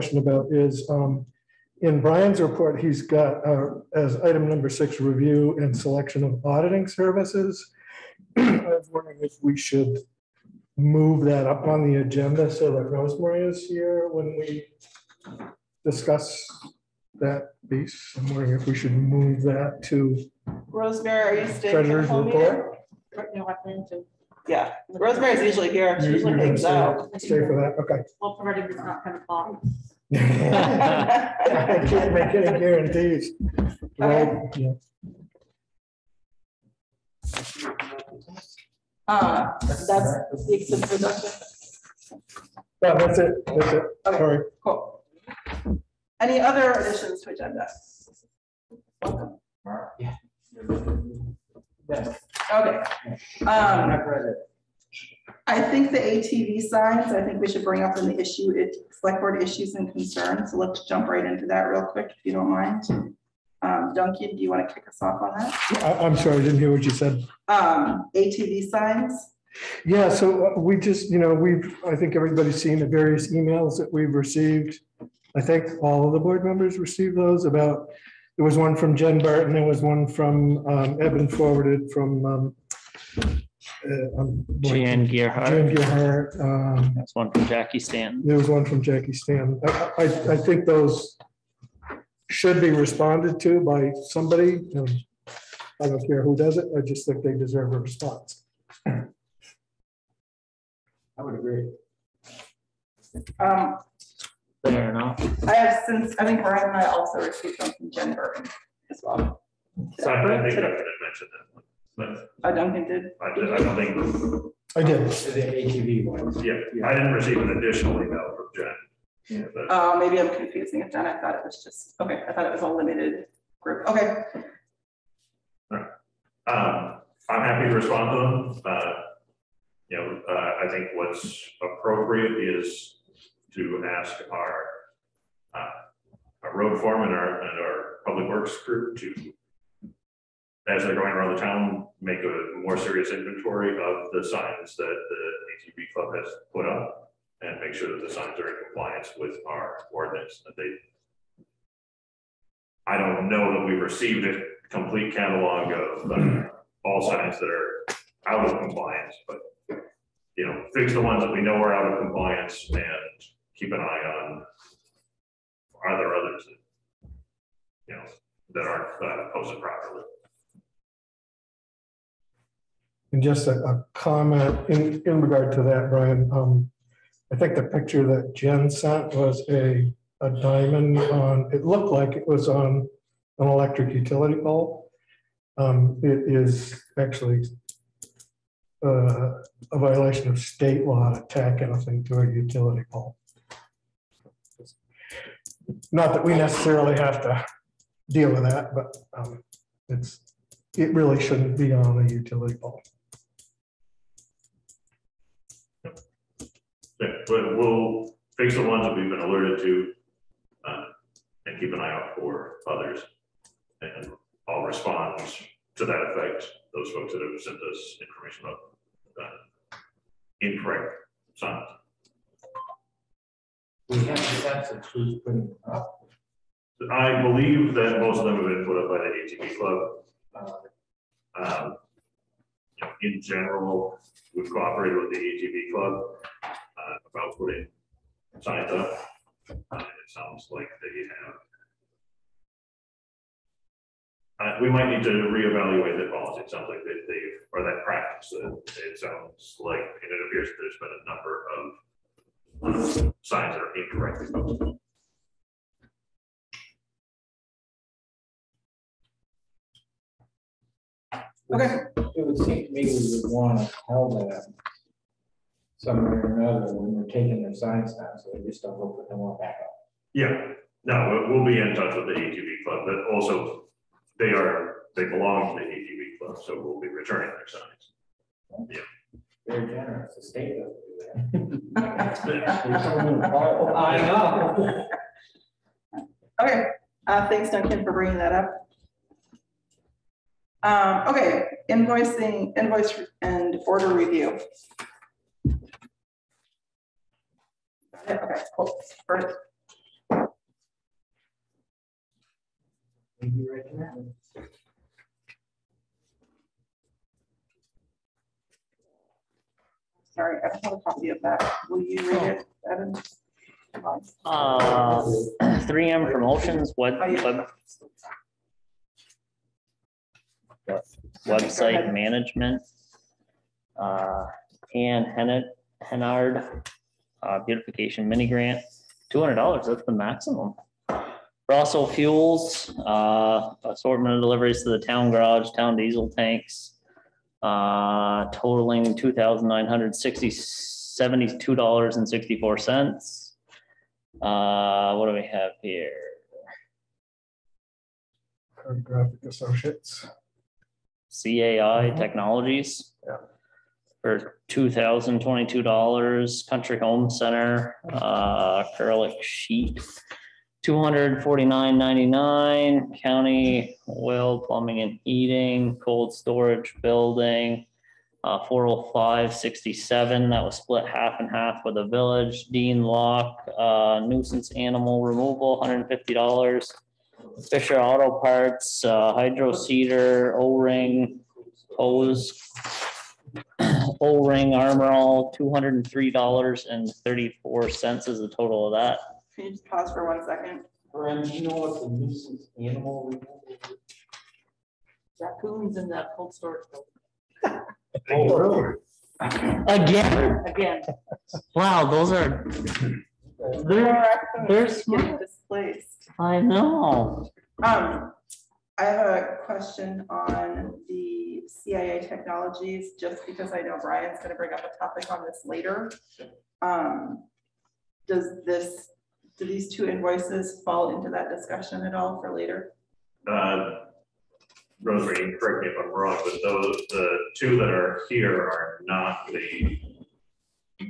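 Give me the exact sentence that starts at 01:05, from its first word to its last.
I, am sorry, I didn't hear what you said.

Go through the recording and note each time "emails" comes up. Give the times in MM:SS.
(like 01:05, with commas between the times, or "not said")
01:13, 01:58.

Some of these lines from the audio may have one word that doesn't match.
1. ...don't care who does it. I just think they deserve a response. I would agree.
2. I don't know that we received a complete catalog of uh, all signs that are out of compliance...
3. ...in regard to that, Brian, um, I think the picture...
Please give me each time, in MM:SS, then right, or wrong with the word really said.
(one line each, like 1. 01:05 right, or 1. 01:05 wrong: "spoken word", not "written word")
1. 01:35 right
2. 02:32 right
3. 02:55 right.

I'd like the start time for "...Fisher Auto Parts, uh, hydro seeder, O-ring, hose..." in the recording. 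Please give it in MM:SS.
06:17.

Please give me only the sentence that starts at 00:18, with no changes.
I'm wondering if we should move that to Rosemary, are you staying treasurer's report?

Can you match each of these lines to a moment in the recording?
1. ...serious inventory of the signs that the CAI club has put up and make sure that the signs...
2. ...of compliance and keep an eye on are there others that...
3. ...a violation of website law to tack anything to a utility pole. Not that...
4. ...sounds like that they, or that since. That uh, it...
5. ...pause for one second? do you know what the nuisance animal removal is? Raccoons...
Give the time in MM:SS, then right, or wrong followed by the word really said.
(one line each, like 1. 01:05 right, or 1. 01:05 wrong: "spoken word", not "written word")
1. 02:22 wrong: "ATV", not "CAI"
2. 02:41 right
3. 03:09 wrong: "state", not "website"
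4. 04:06 wrong: "practice", not "since"
5. 06:29 right.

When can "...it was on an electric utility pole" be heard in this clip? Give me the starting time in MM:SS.
03:02.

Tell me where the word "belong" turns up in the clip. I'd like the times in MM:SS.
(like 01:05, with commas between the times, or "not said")
04:35.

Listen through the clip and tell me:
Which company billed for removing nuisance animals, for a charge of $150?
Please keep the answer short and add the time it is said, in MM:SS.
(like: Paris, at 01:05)
Dean Lock, at 06:12.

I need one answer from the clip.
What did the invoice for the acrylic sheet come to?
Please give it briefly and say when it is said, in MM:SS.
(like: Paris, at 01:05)
$249.99, at 06:00.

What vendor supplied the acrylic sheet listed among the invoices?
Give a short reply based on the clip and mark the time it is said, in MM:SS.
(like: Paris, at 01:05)
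Country Home Center, at 05:56.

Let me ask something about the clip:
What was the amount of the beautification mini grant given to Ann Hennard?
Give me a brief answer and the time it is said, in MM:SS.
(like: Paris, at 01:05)
$200, at 05:29.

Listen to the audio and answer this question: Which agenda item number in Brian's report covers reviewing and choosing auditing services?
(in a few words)
6.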